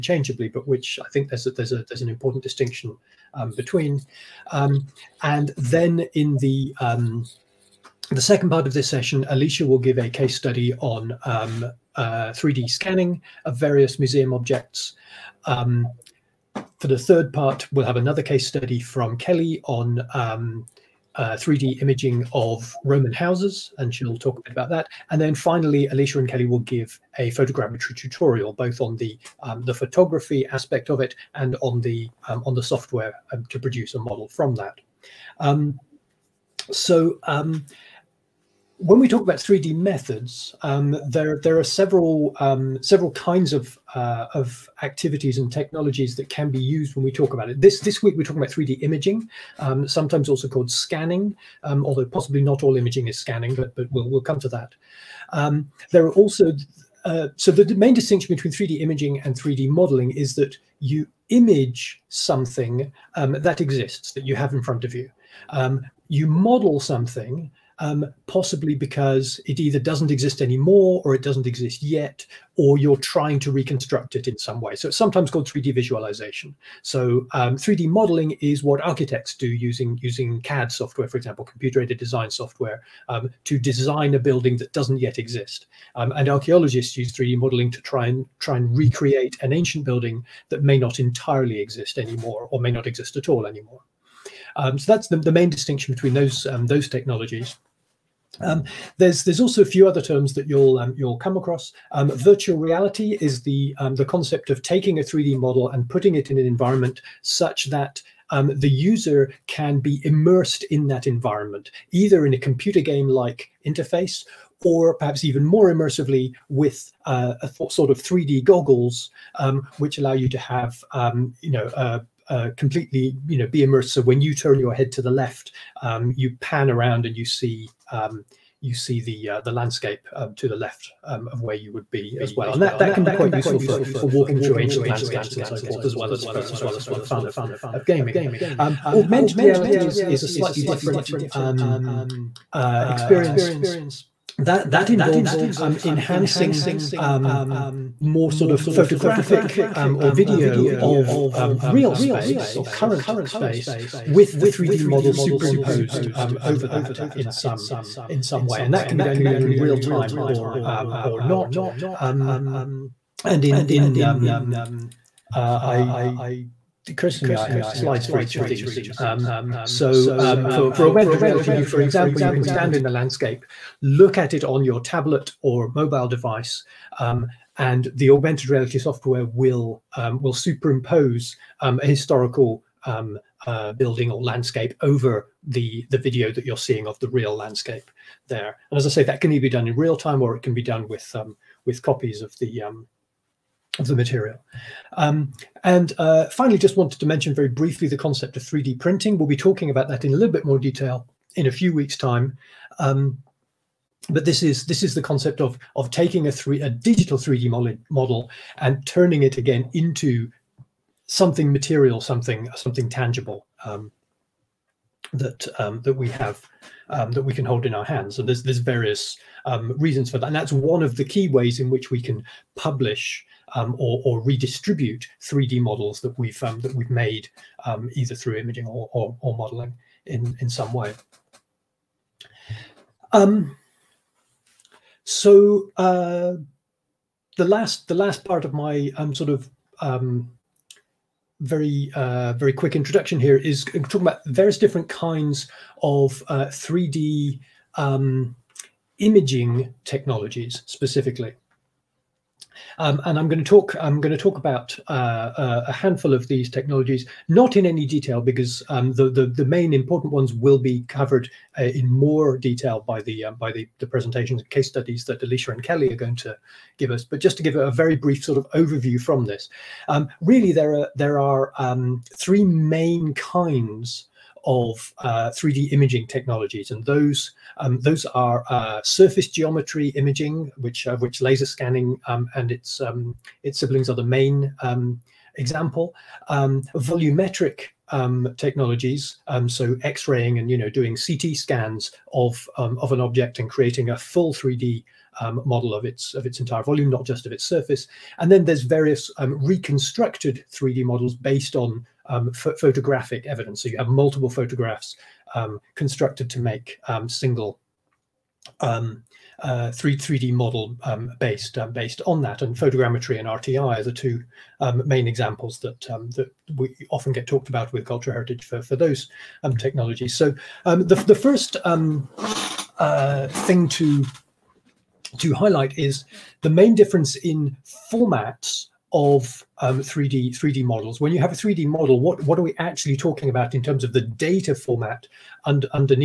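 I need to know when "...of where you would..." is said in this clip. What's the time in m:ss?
2:11.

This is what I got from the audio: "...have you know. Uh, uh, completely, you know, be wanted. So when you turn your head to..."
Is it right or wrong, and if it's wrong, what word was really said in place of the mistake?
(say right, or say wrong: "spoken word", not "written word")
wrong: "immersed", not "wanted".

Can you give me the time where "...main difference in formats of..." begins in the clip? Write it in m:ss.
5:26.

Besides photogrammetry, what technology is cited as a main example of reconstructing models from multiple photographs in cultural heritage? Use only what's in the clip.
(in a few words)
RTI.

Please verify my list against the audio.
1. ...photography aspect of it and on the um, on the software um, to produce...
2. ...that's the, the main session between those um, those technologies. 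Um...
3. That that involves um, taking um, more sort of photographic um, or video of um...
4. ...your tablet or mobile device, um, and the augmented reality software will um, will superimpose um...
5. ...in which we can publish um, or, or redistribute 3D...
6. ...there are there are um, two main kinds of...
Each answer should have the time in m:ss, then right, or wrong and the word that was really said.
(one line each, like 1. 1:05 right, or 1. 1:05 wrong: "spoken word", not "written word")
1. 0:29 right
2. 1:34 wrong: "distinction", not "session"
3. 2:24 wrong: "enhancing", not "taking"
4. 2:54 right
5. 3:41 right
6. 4:30 wrong: "three", not "two".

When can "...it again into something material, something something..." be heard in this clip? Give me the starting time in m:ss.
3:29.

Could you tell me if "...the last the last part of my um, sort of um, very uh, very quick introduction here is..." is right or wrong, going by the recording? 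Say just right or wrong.
right.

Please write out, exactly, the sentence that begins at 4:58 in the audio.
And then there's various um, reconstructed 3D models based on um, photographic evidence.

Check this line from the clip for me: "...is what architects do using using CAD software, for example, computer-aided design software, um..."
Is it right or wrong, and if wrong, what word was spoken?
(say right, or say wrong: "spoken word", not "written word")
right.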